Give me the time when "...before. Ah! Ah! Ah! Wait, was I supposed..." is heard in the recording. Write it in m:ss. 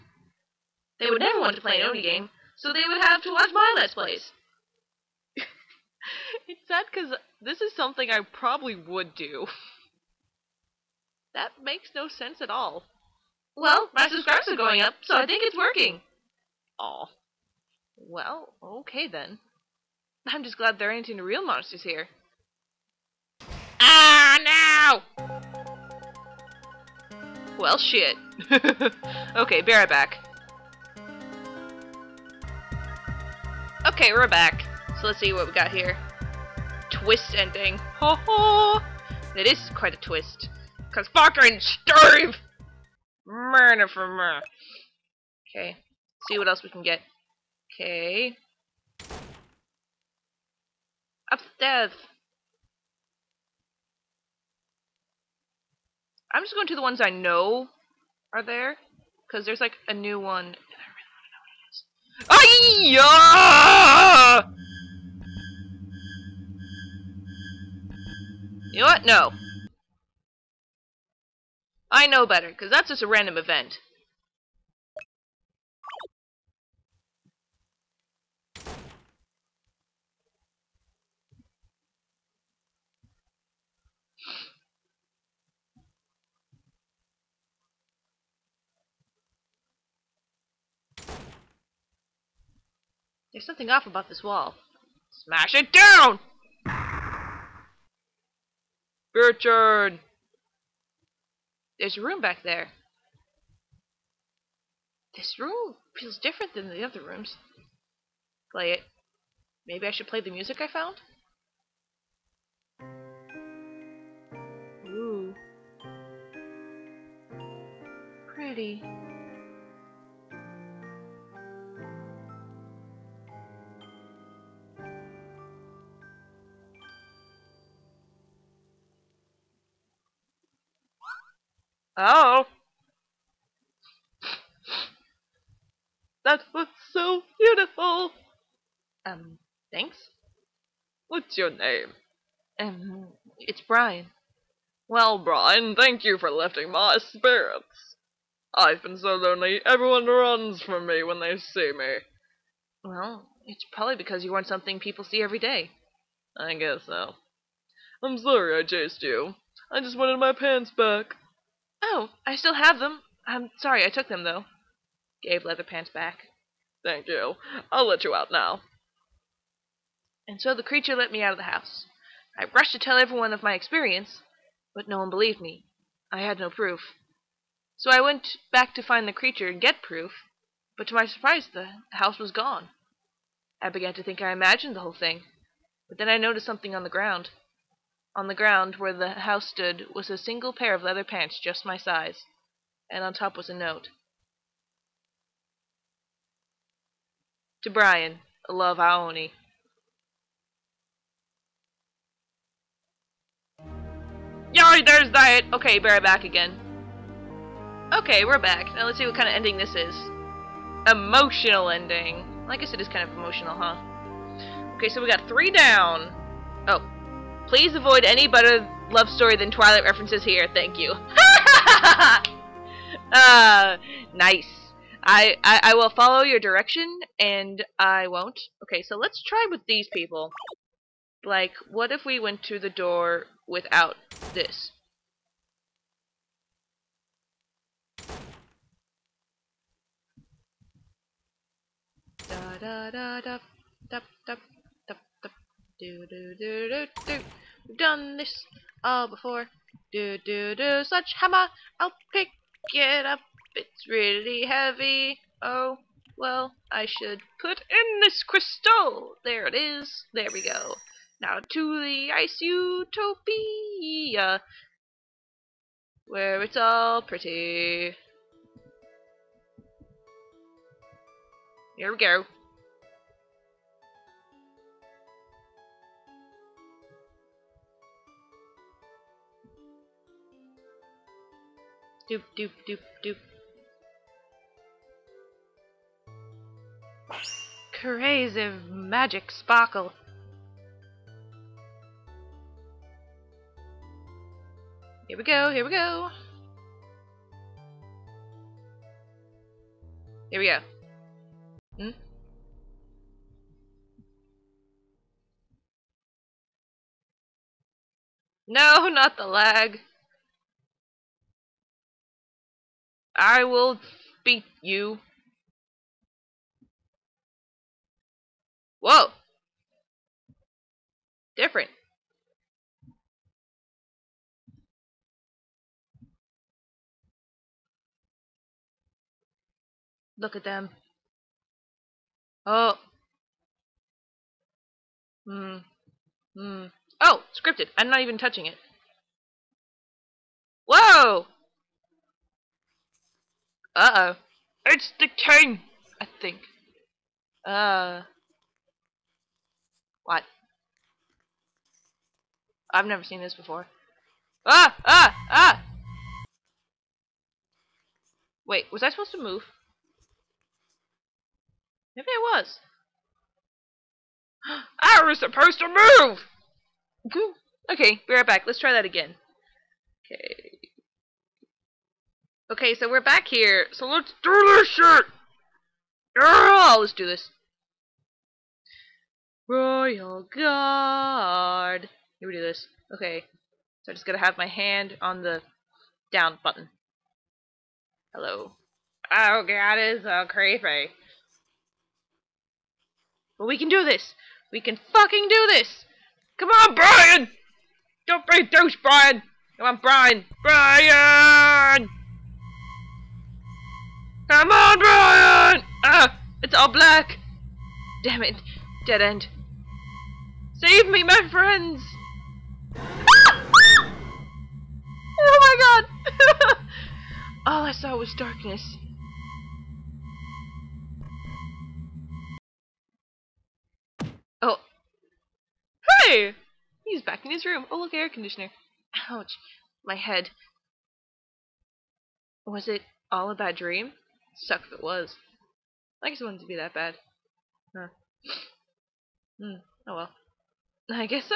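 5:53.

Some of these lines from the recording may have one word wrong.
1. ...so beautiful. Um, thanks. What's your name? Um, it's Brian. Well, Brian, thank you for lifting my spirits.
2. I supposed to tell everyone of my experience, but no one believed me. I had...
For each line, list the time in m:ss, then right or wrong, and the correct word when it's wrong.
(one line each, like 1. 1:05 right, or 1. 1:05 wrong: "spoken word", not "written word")
1. 2:16 right
2. 2:52 wrong: "rushed", not "supposed".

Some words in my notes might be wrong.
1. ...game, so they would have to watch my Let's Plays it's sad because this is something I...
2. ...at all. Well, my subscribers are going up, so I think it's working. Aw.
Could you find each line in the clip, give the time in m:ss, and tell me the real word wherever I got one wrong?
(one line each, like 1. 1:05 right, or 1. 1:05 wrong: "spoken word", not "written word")
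1. 0:02 right
2. 0:12 right.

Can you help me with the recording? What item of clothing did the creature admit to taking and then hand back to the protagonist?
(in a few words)
Leatherpants.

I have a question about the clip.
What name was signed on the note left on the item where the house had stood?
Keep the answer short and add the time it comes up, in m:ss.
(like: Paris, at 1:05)
Aoni, at 3:18.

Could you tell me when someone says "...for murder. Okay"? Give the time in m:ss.
0:43.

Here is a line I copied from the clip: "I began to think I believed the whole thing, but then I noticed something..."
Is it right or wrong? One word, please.
wrong.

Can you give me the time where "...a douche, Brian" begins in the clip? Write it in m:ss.
6:38.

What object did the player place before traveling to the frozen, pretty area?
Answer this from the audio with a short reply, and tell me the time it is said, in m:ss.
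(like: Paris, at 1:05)
crystal, at 4:18.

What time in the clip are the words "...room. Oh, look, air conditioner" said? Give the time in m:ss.
7:07.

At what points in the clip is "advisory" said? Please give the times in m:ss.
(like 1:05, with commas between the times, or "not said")
not said.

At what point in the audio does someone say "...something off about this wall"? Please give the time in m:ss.
1:33.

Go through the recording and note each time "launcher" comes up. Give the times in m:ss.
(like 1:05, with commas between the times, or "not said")
not said.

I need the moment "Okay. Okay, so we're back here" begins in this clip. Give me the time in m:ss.
6:10.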